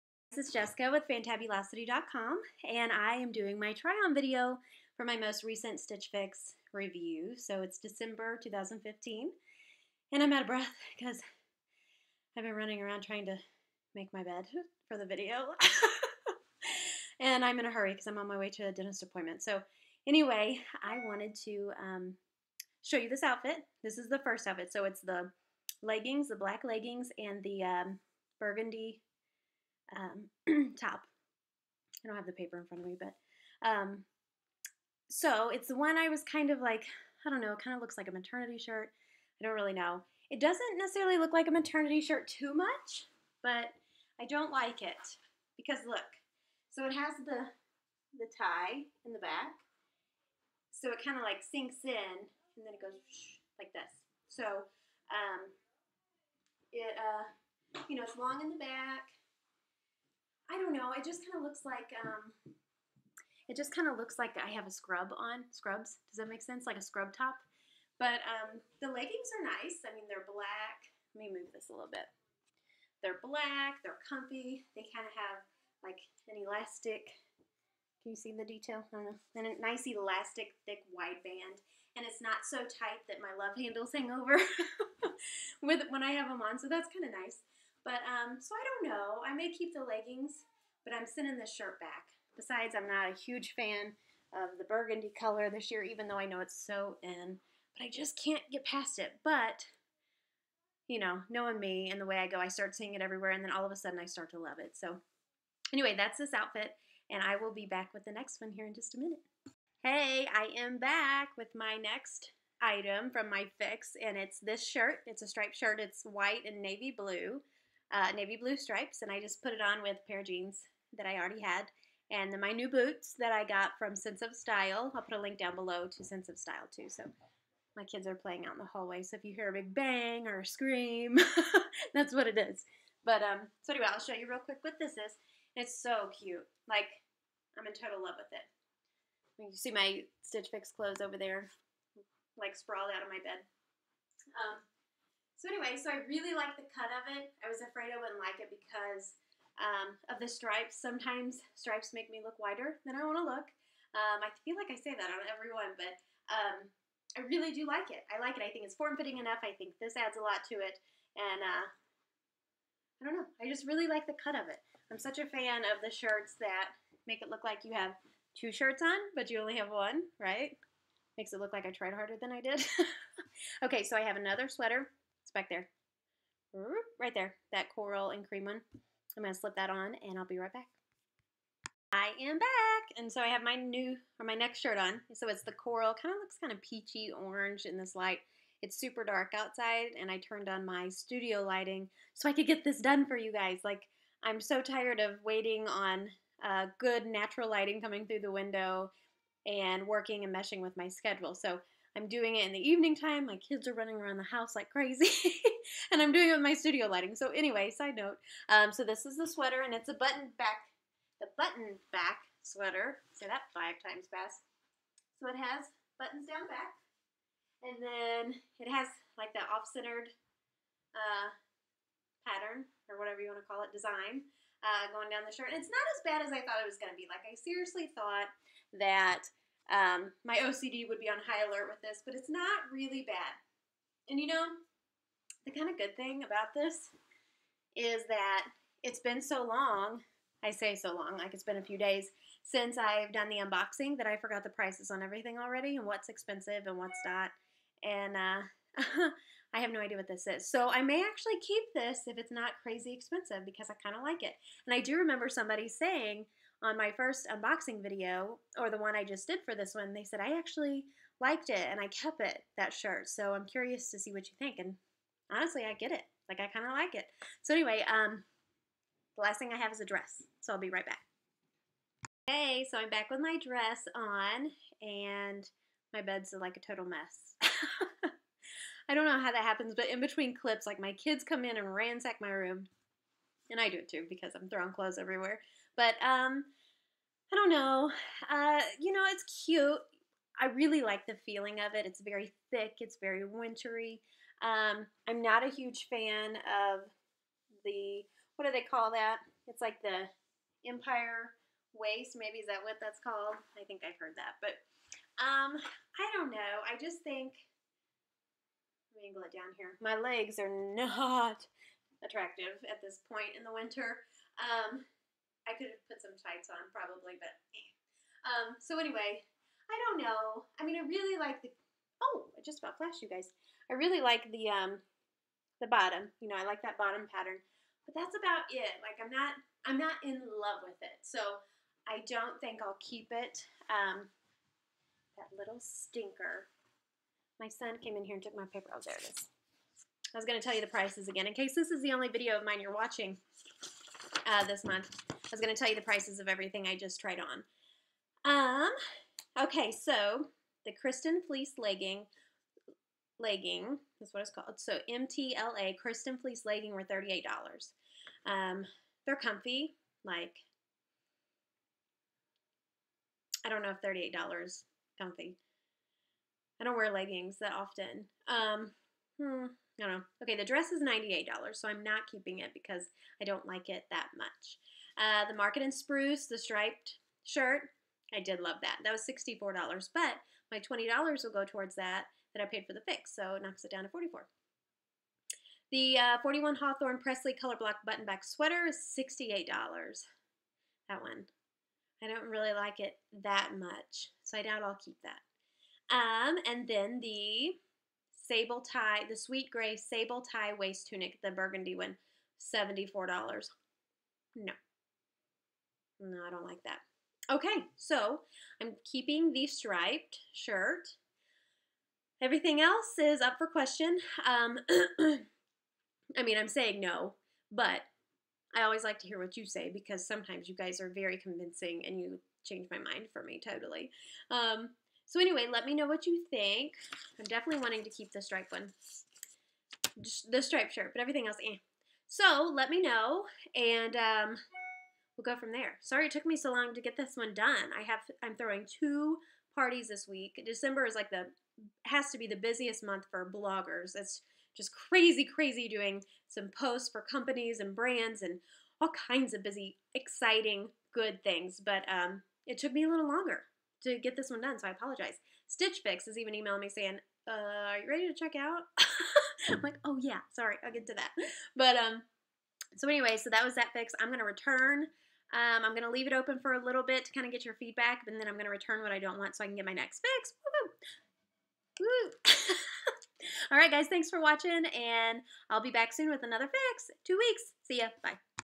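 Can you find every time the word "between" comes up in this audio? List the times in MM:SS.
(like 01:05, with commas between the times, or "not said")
04:39.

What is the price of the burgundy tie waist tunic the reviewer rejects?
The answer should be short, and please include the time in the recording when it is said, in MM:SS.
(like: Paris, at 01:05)
$74, at 06:42.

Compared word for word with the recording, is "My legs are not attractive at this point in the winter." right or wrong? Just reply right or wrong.
right.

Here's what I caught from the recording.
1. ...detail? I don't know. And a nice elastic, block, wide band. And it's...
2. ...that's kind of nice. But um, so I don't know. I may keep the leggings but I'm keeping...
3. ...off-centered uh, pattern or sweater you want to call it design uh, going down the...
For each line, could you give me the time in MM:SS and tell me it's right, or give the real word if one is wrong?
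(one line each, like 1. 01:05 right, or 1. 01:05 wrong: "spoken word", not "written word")
1. 01:18 wrong: "thick", not "block"
2. 01:26 wrong: "sending", not "keeping"
3. 03:39 wrong: "whatever", not "sweater".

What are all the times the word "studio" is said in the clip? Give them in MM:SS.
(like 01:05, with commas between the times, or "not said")
03:10, 03:26.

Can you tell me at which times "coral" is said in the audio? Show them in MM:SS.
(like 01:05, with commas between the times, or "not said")
02:57, 03:05.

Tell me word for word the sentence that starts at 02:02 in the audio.
And then my new boots that I got from Sense of Style.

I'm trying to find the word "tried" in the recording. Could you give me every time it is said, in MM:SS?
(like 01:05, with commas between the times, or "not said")
02:51, 05:46.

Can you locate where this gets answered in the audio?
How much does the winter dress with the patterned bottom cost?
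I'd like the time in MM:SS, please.
06:10.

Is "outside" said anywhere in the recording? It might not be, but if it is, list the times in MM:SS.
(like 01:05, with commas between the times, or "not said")
03:09.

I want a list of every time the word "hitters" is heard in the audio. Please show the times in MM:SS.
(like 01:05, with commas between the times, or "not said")
not said.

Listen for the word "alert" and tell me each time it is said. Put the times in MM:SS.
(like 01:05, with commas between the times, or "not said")
03:51.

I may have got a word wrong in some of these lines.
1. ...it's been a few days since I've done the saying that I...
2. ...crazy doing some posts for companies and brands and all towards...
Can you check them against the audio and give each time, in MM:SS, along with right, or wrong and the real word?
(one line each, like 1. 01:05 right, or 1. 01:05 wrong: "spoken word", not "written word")
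1. 04:01 wrong: "unboxing", not "saying"
2. 07:25 wrong: "kinds", not "towards".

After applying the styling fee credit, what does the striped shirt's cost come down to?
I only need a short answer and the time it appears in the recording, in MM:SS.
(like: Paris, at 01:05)
$44, at 06:23.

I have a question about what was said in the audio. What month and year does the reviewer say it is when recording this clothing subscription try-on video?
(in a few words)
December 2015.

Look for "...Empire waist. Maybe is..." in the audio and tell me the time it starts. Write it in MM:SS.
05:00.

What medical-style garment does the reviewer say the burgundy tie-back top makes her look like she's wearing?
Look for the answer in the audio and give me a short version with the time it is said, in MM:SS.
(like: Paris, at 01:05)
Scrubs, at 01:05.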